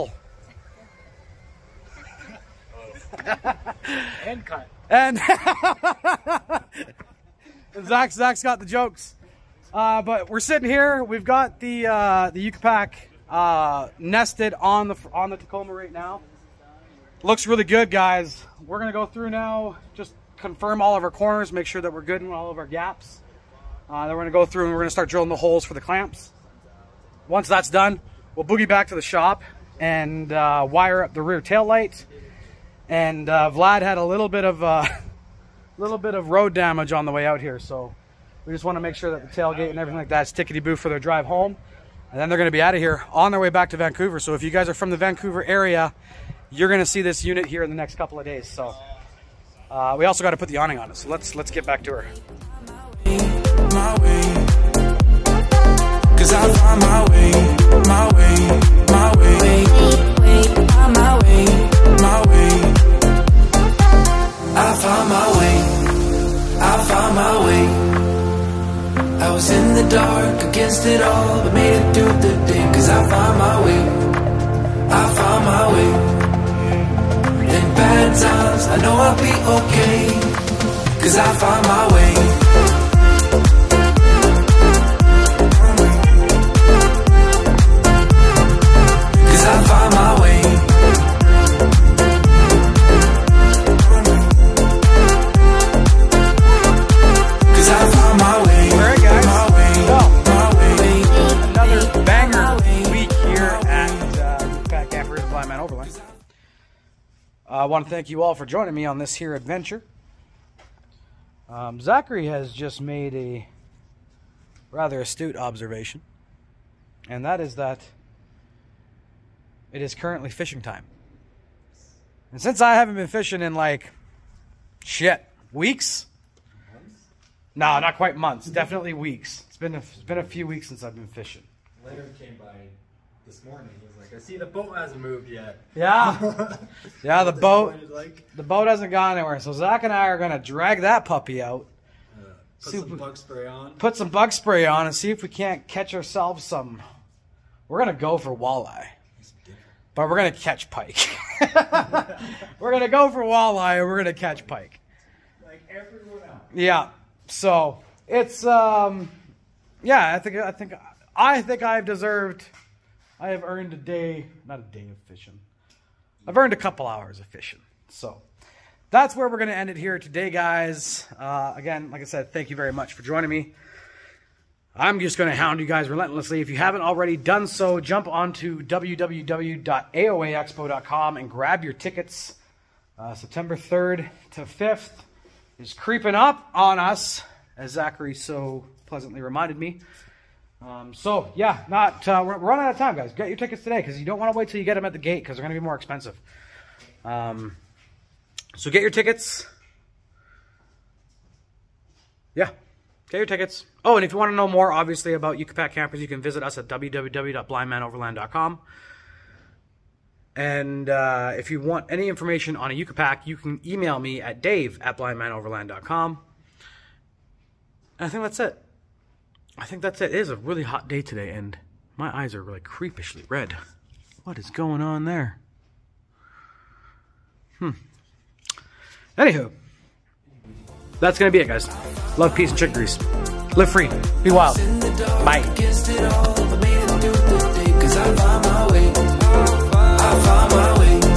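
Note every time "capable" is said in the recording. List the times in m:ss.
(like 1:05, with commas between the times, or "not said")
not said.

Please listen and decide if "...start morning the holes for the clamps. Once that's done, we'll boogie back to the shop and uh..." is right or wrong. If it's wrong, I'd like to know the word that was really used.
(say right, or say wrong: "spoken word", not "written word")
wrong: "drilling", not "morning".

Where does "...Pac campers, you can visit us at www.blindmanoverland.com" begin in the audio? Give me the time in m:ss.
3:25.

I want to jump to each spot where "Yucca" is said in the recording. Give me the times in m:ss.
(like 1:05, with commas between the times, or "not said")
0:12, 3:25.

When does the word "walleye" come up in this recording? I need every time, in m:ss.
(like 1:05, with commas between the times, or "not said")
2:28, 2:33.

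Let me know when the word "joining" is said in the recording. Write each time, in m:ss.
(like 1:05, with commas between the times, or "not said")
1:48, 2:53.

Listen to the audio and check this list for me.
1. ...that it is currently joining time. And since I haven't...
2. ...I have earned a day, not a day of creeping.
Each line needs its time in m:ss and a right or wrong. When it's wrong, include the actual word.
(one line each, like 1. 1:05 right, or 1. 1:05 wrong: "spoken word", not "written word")
1. 1:57 wrong: "fishing", not "joining"
2. 2:43 wrong: "fishing", not "creeping".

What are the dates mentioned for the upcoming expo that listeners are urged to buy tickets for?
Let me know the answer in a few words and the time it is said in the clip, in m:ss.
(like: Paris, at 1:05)
September 3rd to 5th, at 3:03.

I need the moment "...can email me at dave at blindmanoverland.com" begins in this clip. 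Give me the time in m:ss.
3:33.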